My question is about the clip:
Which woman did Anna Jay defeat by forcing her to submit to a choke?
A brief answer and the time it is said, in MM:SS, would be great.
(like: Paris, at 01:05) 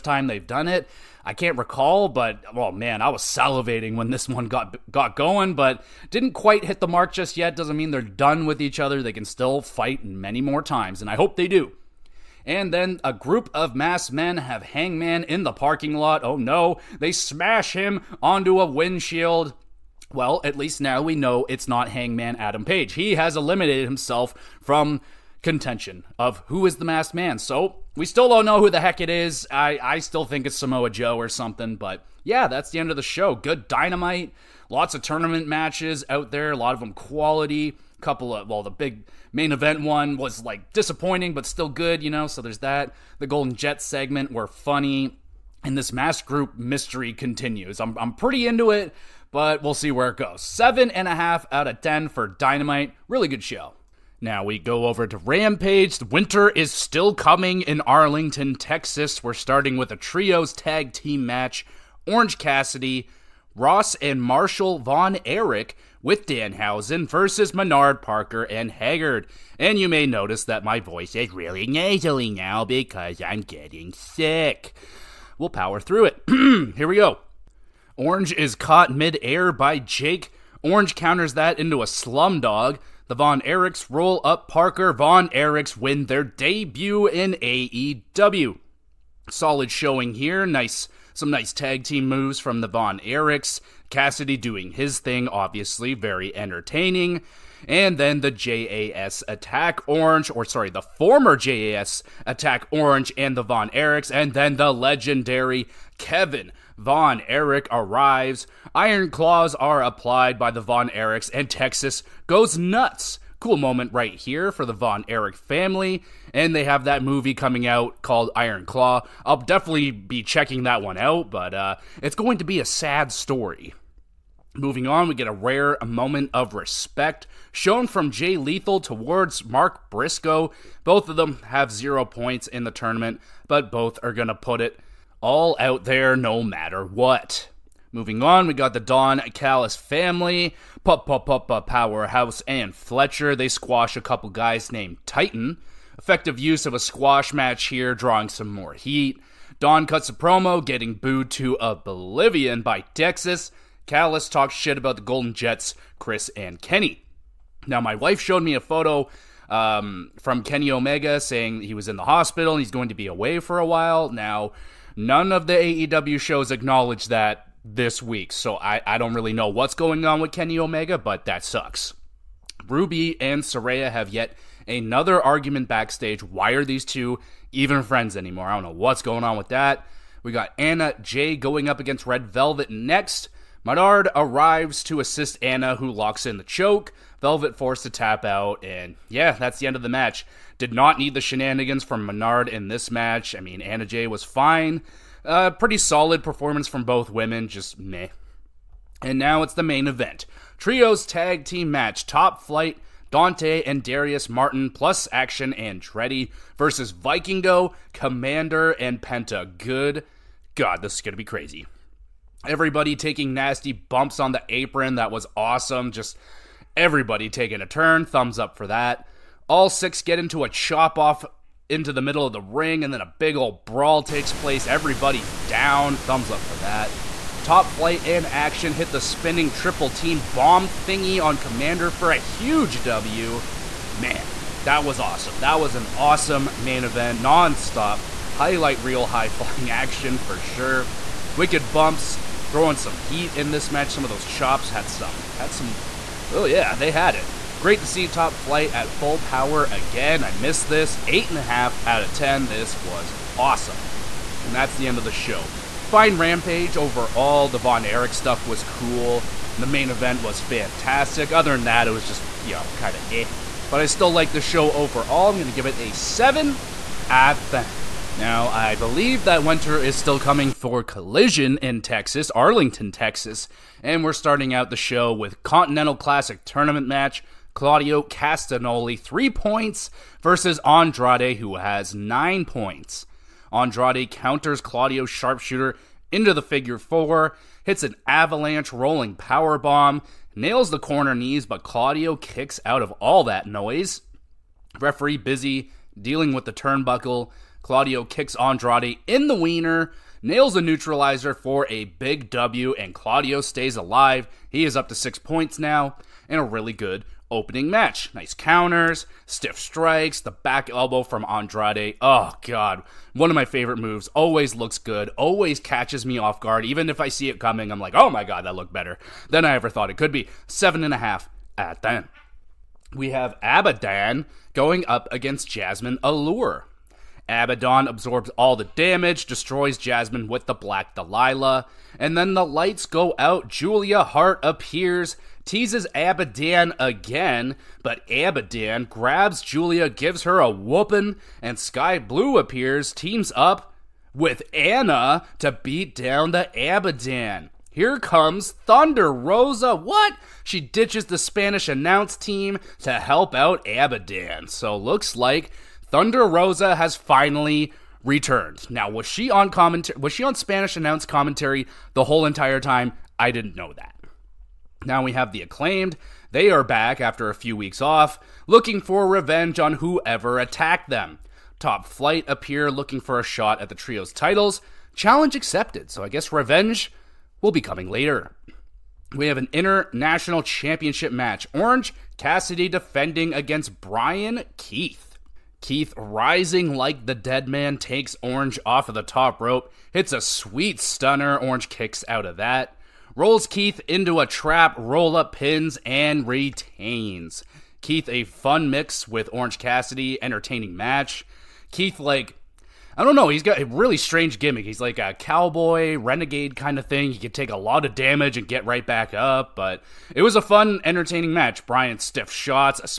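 Red Velvet, at 03:02.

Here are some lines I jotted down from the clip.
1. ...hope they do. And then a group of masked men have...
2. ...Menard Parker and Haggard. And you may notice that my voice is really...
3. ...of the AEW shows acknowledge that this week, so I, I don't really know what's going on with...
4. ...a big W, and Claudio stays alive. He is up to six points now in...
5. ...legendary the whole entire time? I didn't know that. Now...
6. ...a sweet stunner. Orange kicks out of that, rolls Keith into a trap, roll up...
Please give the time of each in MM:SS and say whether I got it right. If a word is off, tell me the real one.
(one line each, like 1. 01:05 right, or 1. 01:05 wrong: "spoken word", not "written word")
1. 00:11 right
2. 01:07 right
3. 02:45 right
4. 05:01 right
5. 06:01 wrong: "commentary", not "legendary"
6. 06:30 right.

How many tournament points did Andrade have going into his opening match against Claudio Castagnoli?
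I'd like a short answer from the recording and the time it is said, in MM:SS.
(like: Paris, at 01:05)
9, at 04:41.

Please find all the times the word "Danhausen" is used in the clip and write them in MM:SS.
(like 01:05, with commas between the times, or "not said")
01:06.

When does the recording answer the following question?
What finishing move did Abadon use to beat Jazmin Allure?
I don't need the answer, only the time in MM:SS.
05:30.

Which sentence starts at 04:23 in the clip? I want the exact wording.
But I still like the show overall.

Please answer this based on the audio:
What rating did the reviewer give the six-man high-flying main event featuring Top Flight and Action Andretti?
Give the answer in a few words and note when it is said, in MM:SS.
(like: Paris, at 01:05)
8.5 out of 10, at 04:11.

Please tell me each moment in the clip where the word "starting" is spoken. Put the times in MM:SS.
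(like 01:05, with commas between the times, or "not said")
00:59, 04:34.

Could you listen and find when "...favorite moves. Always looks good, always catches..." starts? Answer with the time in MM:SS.
05:13.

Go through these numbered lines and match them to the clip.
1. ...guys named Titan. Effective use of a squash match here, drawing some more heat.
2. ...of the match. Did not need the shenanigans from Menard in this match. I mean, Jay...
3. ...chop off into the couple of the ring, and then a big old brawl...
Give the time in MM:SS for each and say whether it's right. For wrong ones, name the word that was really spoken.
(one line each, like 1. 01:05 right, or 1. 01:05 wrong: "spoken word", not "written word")
1. 02:24 right
2. 03:09 wrong: "Anna", not "Jay"
3. 03:40 wrong: "middle", not "couple".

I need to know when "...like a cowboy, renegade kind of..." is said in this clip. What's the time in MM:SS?
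06:44.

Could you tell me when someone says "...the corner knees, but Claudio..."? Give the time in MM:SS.
04:50.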